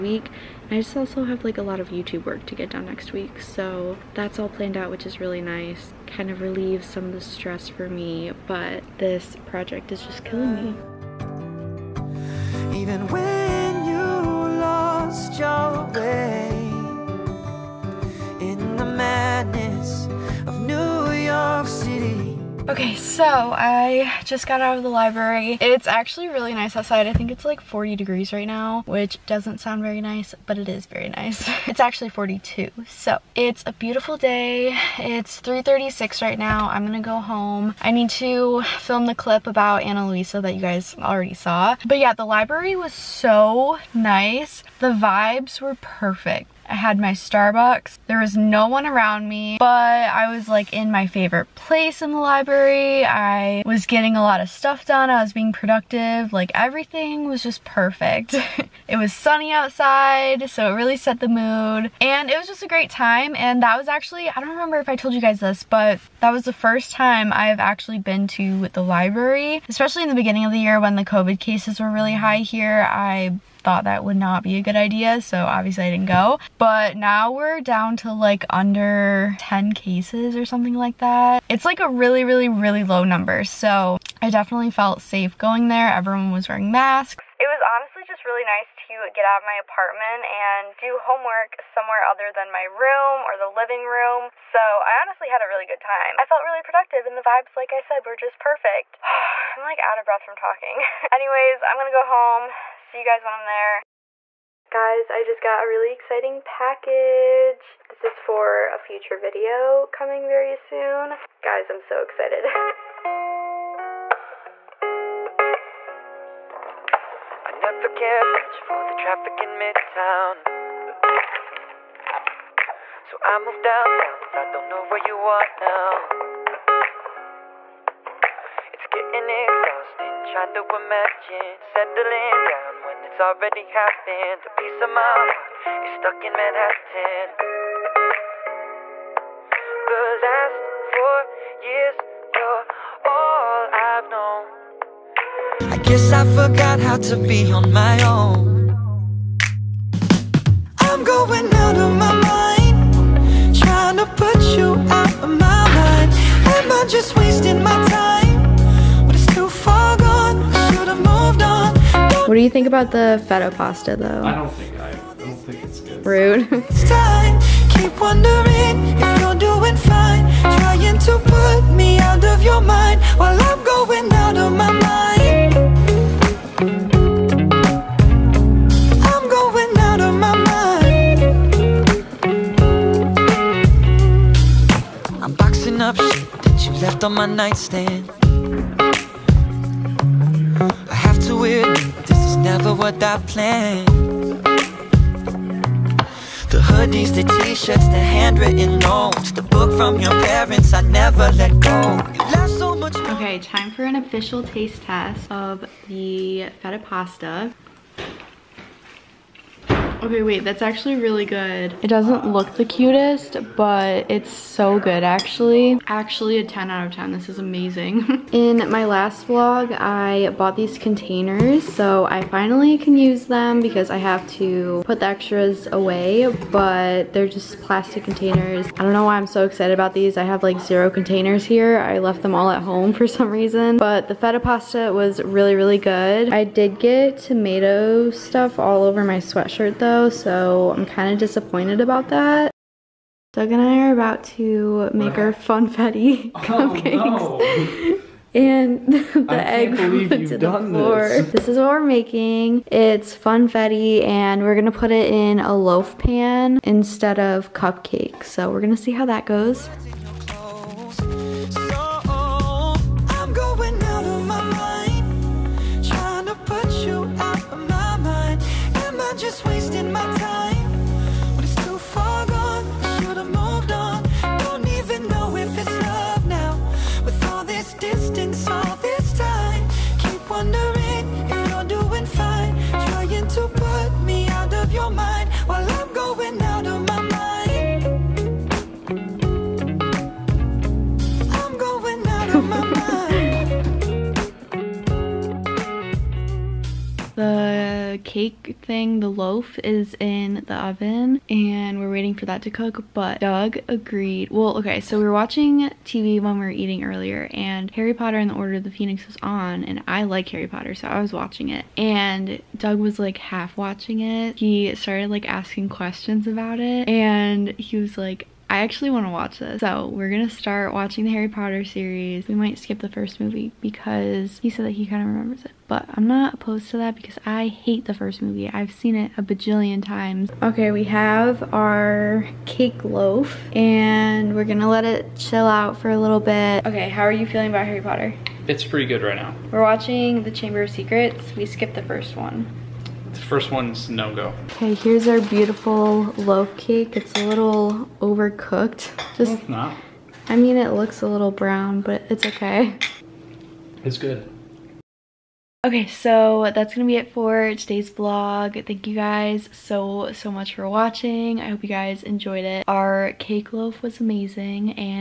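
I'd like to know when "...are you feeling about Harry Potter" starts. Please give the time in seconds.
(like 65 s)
337 s.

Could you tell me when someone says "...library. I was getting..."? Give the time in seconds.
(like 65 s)
52 s.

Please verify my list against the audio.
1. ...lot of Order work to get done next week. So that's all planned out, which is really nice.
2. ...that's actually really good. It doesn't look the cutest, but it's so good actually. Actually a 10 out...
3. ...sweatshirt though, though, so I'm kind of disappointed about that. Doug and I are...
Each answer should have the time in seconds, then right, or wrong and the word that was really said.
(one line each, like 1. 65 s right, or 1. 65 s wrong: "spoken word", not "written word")
1. 1 s wrong: "YouTube", not "Order"
2. 210 s right
3. 239 s right.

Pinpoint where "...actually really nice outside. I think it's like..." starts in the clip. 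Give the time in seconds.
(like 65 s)
25 s.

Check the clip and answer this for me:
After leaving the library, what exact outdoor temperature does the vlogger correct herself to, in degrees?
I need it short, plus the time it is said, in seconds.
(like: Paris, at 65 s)
42, at 31 s.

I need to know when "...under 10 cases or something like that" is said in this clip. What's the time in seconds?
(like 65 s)
78 s.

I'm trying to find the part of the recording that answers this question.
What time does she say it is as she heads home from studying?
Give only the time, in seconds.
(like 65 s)
35 s.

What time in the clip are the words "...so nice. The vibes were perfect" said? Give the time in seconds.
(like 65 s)
42 s.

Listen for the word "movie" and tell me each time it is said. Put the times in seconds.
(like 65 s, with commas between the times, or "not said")
323 s, 328 s.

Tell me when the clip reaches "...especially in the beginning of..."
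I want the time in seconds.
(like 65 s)
69 s.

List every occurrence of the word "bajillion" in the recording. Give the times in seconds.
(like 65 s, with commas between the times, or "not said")
329 s.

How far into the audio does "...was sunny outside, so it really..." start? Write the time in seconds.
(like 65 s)
58 s.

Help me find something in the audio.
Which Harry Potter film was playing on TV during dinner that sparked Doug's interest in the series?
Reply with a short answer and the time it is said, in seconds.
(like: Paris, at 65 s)
Order of the Phoenix, at 308 s.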